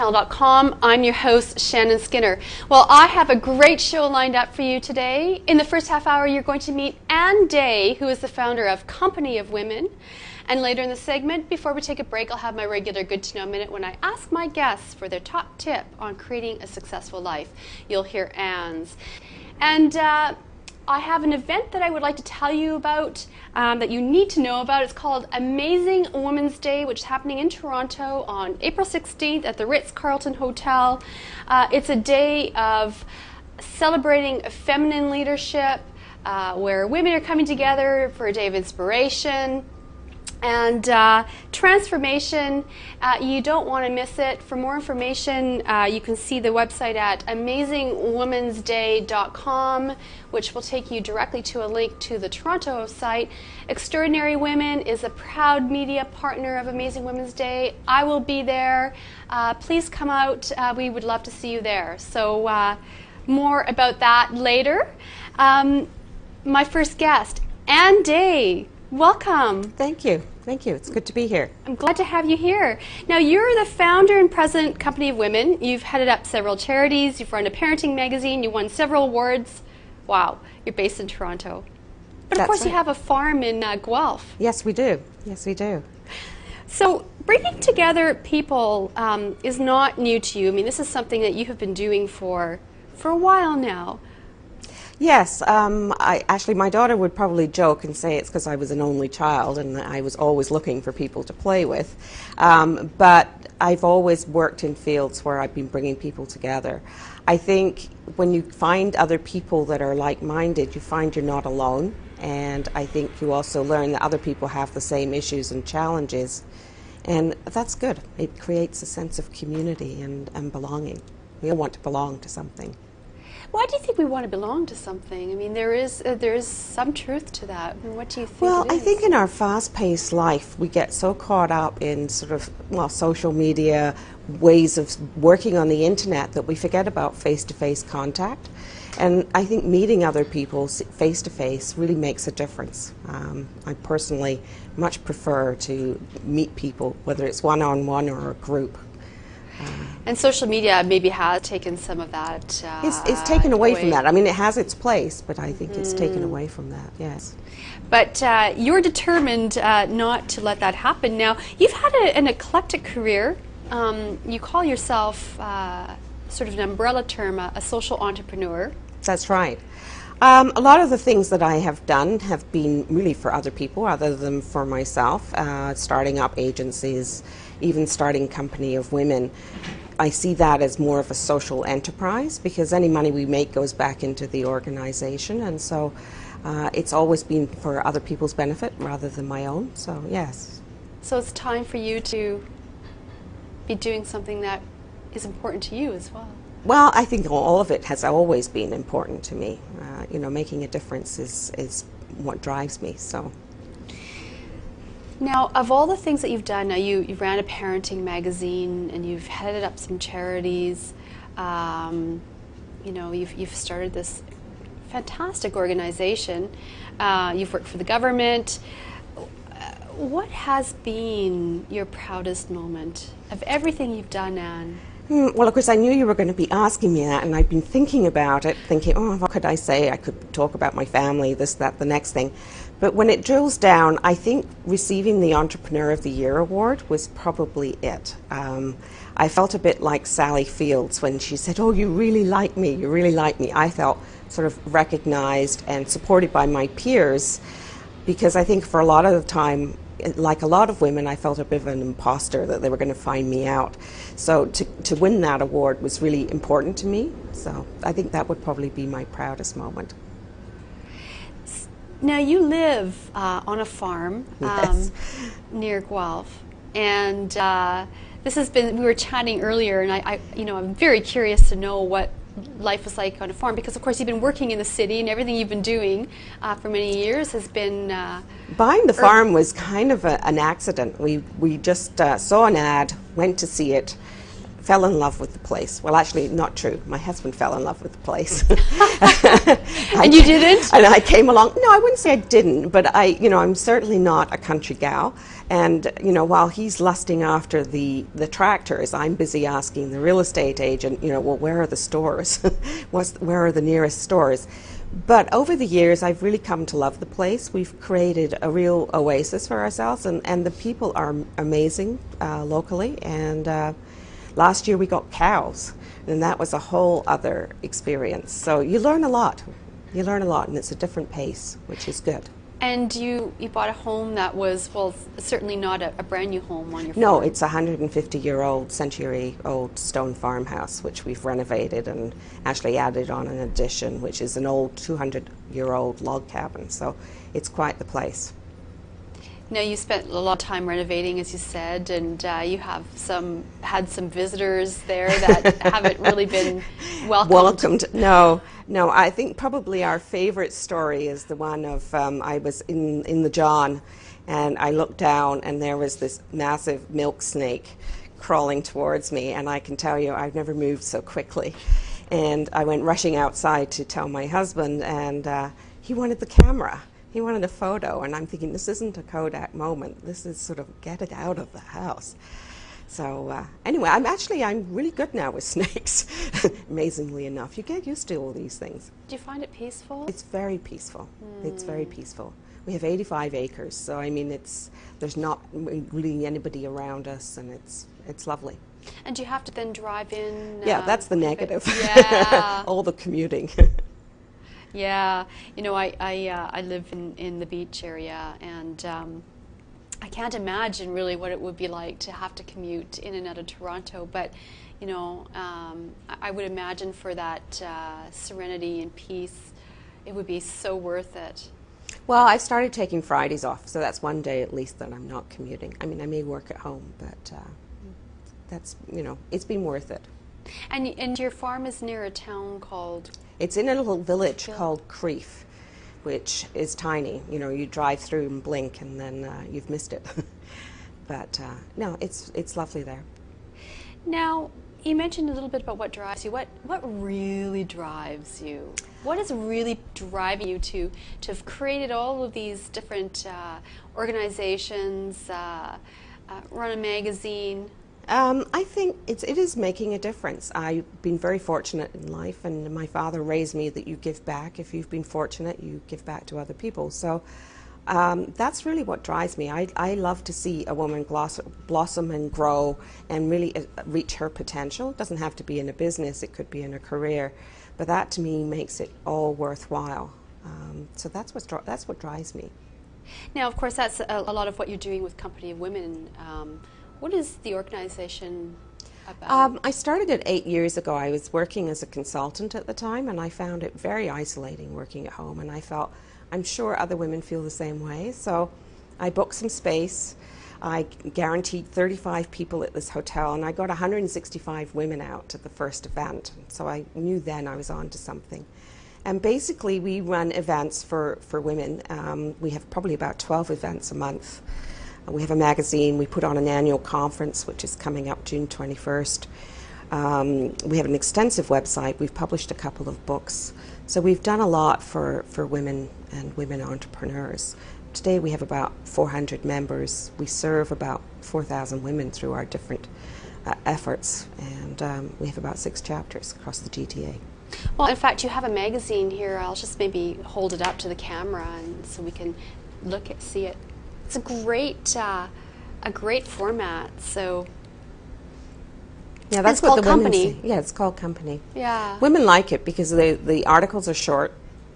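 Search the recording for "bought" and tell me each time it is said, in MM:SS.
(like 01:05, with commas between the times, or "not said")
05:23.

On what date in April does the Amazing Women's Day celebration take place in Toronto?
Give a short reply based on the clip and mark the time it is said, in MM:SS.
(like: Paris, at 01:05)
April 16, at 00:28.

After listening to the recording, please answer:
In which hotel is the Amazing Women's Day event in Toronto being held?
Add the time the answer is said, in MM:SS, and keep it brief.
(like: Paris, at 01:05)
Ritz Carlton, at 00:29.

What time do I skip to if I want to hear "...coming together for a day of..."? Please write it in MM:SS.
00:37.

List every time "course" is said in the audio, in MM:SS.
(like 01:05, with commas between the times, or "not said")
01:22, 03:45, 04:33, 07:53.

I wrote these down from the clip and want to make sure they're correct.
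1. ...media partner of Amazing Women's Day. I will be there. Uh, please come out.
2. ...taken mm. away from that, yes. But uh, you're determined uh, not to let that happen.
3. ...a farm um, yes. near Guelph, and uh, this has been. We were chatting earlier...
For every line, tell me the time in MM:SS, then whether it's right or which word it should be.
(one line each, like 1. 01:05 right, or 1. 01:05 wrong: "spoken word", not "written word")
1. 00:55 right
2. 02:35 right
3. 04:23 right.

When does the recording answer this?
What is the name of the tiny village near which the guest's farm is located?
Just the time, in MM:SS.
07:04.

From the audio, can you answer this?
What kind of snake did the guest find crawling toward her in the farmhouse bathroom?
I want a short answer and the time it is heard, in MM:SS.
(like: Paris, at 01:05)
milk snake, at 05:56.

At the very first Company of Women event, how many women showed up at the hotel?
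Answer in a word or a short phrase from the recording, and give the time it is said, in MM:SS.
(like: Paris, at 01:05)
165, at 08:13.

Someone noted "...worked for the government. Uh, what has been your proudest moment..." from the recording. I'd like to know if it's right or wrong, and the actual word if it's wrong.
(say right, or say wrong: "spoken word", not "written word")
right.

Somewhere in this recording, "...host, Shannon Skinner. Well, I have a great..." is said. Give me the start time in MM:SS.
00:01.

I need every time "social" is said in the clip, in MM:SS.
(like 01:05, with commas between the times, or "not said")
02:12, 02:30, 02:47, 03:01.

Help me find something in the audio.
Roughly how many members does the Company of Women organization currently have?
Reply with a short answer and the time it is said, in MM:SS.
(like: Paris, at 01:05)
400, at 08:38.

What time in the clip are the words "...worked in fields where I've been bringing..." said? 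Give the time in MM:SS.
01:44.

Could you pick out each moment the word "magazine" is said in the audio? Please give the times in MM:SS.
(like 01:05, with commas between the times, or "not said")
01:17, 03:28, 07:26, 08:25, 08:48.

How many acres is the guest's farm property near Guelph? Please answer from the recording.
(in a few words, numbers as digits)
85.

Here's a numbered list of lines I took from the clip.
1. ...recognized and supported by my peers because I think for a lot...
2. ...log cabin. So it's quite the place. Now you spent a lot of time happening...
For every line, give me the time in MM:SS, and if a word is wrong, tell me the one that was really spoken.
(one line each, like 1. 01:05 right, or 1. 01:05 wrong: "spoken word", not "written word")
1. 04:04 right
2. 05:36 wrong: "renovating", not "happening".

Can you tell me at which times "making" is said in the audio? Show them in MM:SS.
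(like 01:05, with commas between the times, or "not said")
03:20, 07:29.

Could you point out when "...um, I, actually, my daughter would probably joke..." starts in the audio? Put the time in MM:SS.
01:35.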